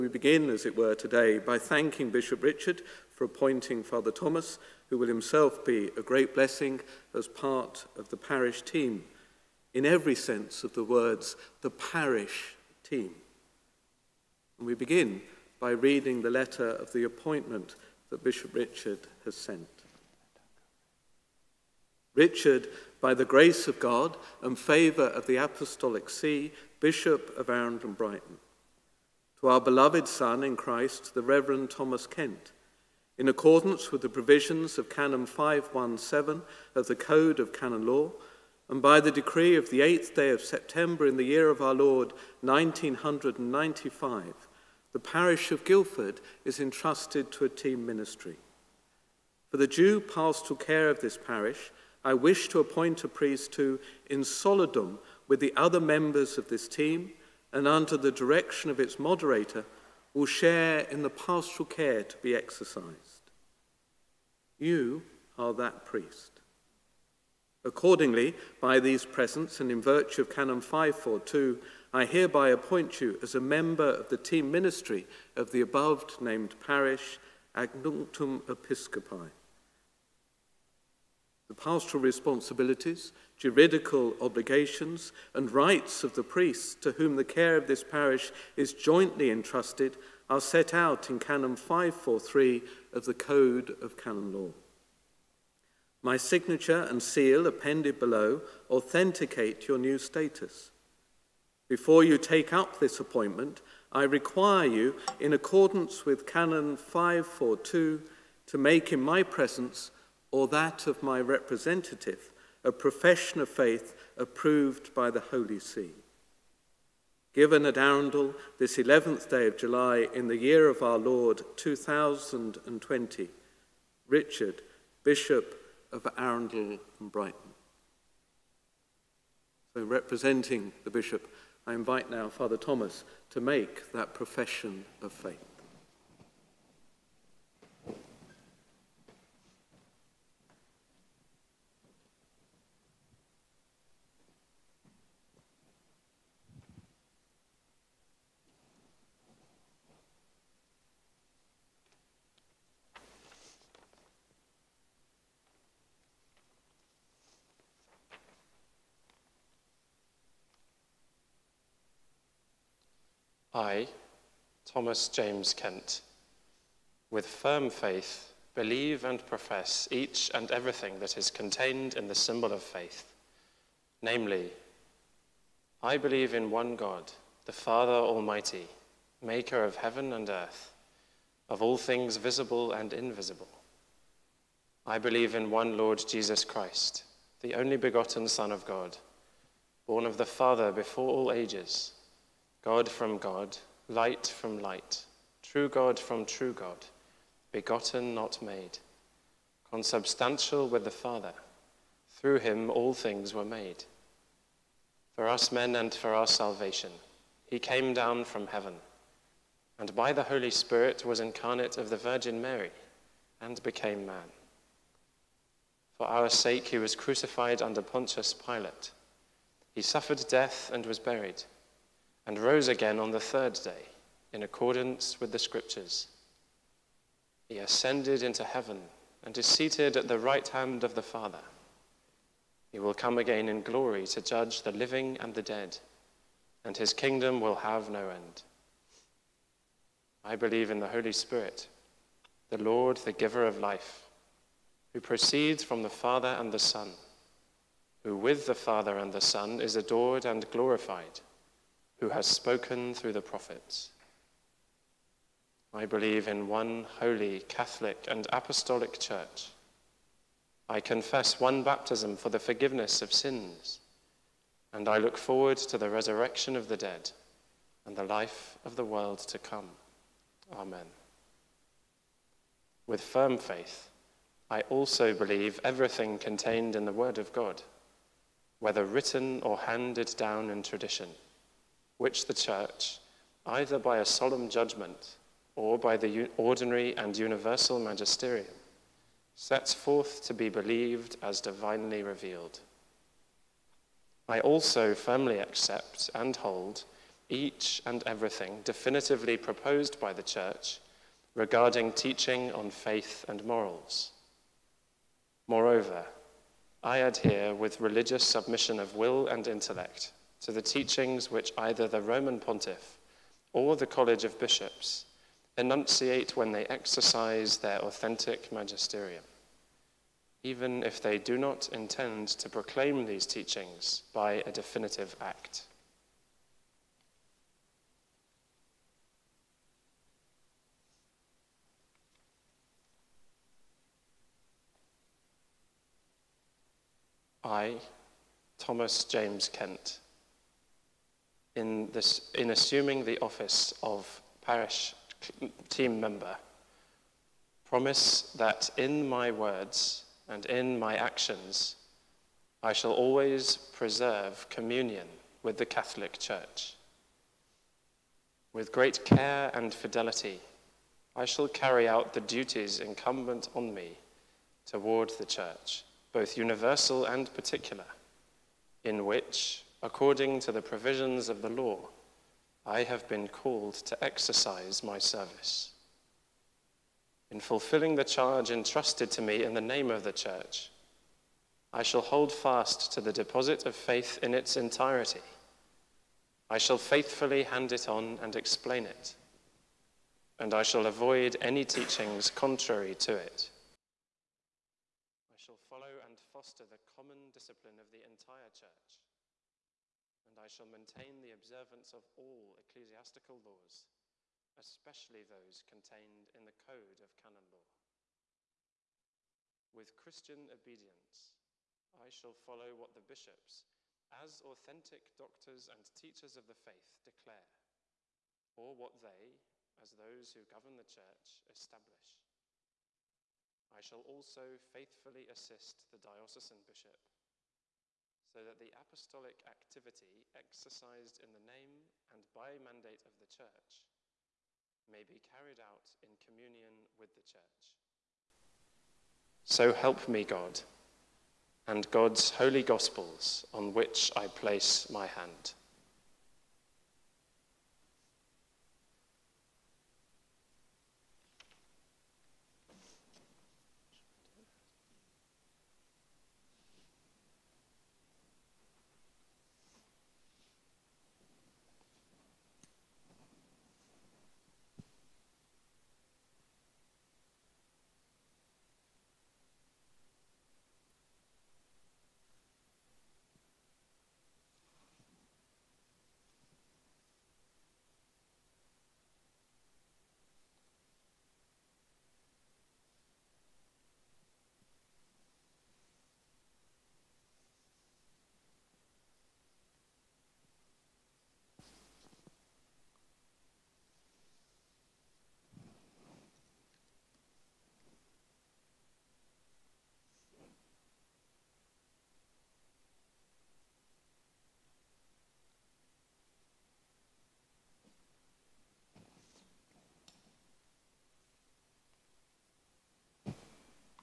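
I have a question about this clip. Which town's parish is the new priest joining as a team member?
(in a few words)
Guildford.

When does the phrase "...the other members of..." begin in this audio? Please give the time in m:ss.
0:55.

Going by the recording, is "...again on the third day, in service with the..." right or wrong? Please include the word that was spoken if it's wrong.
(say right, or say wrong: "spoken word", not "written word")
wrong: "accordance", not "service".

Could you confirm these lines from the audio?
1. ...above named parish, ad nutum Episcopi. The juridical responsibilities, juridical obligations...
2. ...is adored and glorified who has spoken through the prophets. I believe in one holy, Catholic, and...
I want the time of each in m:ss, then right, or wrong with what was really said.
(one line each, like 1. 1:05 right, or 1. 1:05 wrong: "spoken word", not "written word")
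1. 1:15 wrong: "pastoral", not "juridical"
2. 4:09 right.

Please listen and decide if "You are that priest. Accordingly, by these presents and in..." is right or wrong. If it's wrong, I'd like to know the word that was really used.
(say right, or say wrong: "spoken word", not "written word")
right.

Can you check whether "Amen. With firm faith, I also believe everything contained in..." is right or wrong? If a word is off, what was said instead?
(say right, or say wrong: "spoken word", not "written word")
right.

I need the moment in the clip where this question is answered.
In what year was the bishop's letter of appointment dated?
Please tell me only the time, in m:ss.
2:01.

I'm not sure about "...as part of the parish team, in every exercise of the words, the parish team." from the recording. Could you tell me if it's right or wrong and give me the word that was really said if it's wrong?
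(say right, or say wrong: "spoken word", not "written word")
wrong: "sense", not "exercise".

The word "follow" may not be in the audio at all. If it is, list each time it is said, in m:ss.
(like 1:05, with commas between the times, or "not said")
6:35, 6:52.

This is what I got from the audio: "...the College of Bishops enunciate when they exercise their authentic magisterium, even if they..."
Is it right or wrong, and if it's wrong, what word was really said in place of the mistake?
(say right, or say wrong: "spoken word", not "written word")
right.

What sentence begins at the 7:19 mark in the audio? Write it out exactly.
So help me, God, and God's holy gospels on which I place my hand.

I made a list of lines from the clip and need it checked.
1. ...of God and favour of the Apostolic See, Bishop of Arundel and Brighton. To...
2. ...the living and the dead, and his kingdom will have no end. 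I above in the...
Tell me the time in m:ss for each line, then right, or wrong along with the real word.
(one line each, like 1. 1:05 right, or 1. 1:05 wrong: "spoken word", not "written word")
1. 0:23 right
2. 3:54 wrong: "believe", not "above".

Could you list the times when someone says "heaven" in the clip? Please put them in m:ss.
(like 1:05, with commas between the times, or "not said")
2:59, 3:28, 3:48.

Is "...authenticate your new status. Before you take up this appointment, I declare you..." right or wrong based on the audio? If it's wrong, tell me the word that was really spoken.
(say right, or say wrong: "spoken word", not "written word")
wrong: "require", not "declare".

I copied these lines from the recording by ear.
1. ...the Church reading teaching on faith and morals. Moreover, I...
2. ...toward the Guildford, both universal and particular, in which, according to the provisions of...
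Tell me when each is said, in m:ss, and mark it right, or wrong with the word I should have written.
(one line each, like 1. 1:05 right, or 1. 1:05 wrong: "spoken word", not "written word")
1. 5:00 wrong: "regarding", not "reading"
2. 6:04 wrong: "Church", not "Guildford".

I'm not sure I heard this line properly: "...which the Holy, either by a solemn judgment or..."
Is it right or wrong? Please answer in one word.
wrong.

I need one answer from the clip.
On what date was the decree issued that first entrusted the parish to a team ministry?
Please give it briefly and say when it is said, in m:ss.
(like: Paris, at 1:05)
8 September 1995, at 0:39.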